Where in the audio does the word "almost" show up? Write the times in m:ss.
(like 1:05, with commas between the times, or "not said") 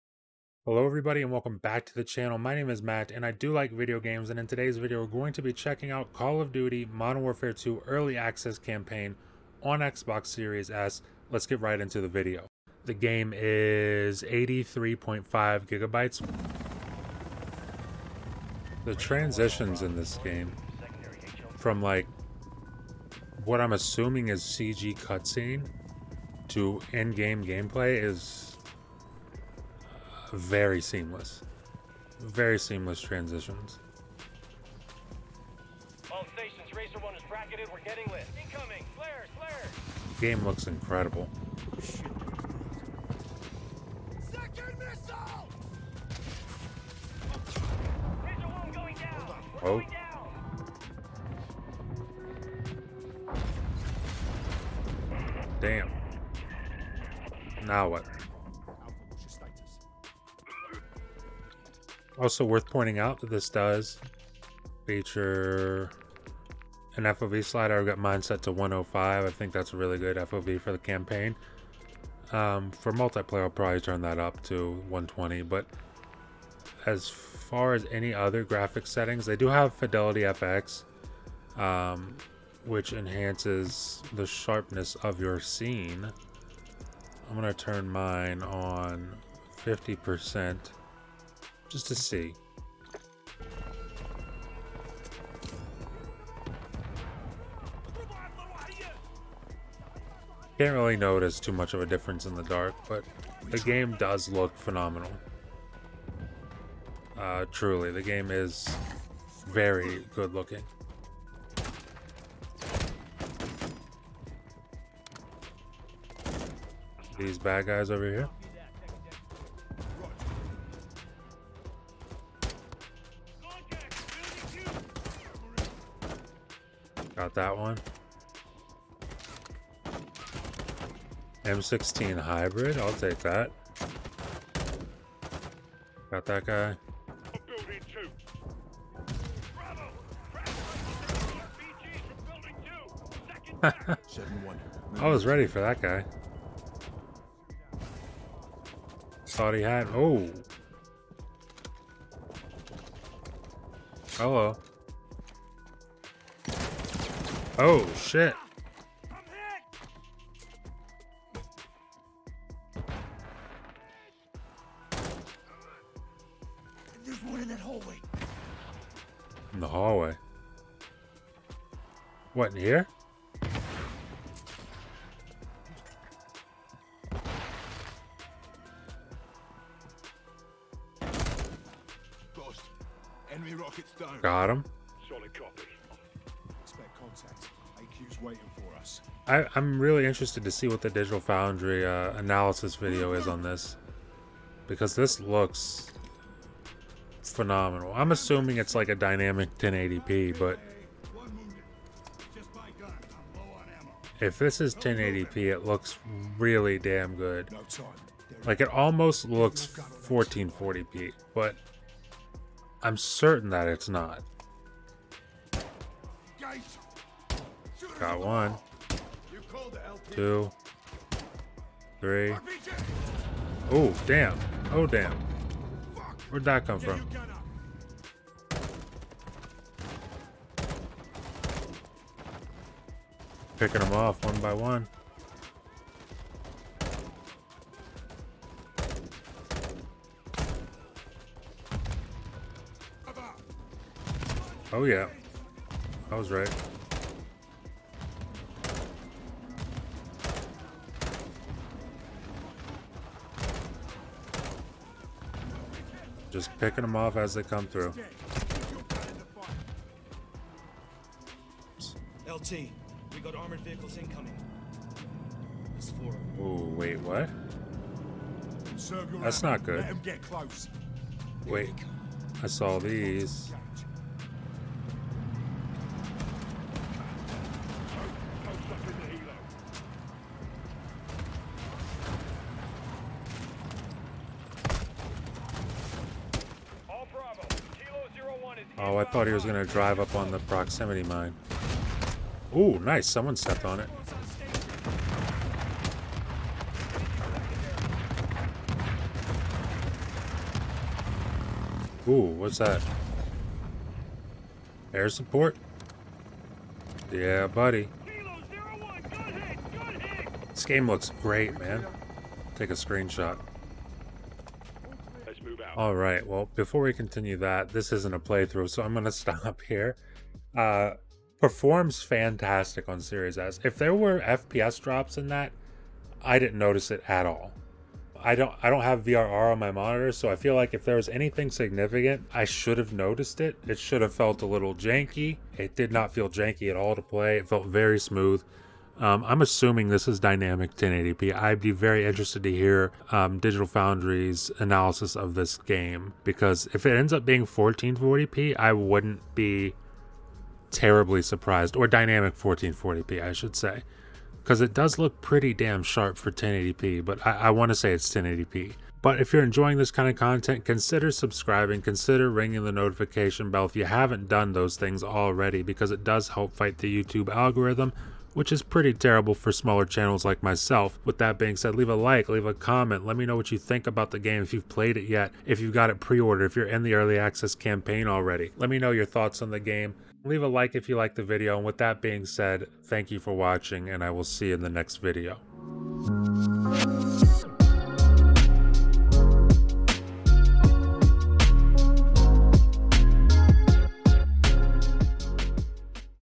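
3:28.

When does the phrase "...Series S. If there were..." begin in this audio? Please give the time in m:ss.
5:22.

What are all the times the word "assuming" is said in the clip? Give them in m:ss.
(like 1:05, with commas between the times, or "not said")
0:23, 3:18, 5:39.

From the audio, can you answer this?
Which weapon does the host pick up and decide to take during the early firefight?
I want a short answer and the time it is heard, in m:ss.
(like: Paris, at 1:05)
M16 hybrid, at 2:11.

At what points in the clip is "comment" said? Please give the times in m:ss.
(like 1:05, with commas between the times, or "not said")
6:12.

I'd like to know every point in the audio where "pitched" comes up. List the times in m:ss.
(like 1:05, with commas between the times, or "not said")
not said.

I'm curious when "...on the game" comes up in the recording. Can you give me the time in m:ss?
6:19.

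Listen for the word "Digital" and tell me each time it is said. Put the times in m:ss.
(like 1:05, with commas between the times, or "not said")
3:10, 5:43.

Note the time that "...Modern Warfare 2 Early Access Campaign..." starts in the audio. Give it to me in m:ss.
0:06.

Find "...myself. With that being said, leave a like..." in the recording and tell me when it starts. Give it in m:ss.
6:10.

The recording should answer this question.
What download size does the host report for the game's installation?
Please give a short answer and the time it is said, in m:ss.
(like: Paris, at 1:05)
83.5 gigabytes, at 0:14.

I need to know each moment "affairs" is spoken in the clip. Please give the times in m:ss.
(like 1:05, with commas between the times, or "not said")
not said.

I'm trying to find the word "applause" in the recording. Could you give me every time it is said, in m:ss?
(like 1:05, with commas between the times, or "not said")
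not said.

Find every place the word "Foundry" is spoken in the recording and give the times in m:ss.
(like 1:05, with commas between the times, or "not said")
3:11, 5:43.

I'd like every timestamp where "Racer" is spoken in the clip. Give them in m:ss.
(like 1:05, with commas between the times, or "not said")
0:36, 0:48.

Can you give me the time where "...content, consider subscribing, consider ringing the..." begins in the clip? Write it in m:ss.
6:00.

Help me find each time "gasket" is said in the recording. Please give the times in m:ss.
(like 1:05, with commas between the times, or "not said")
not said.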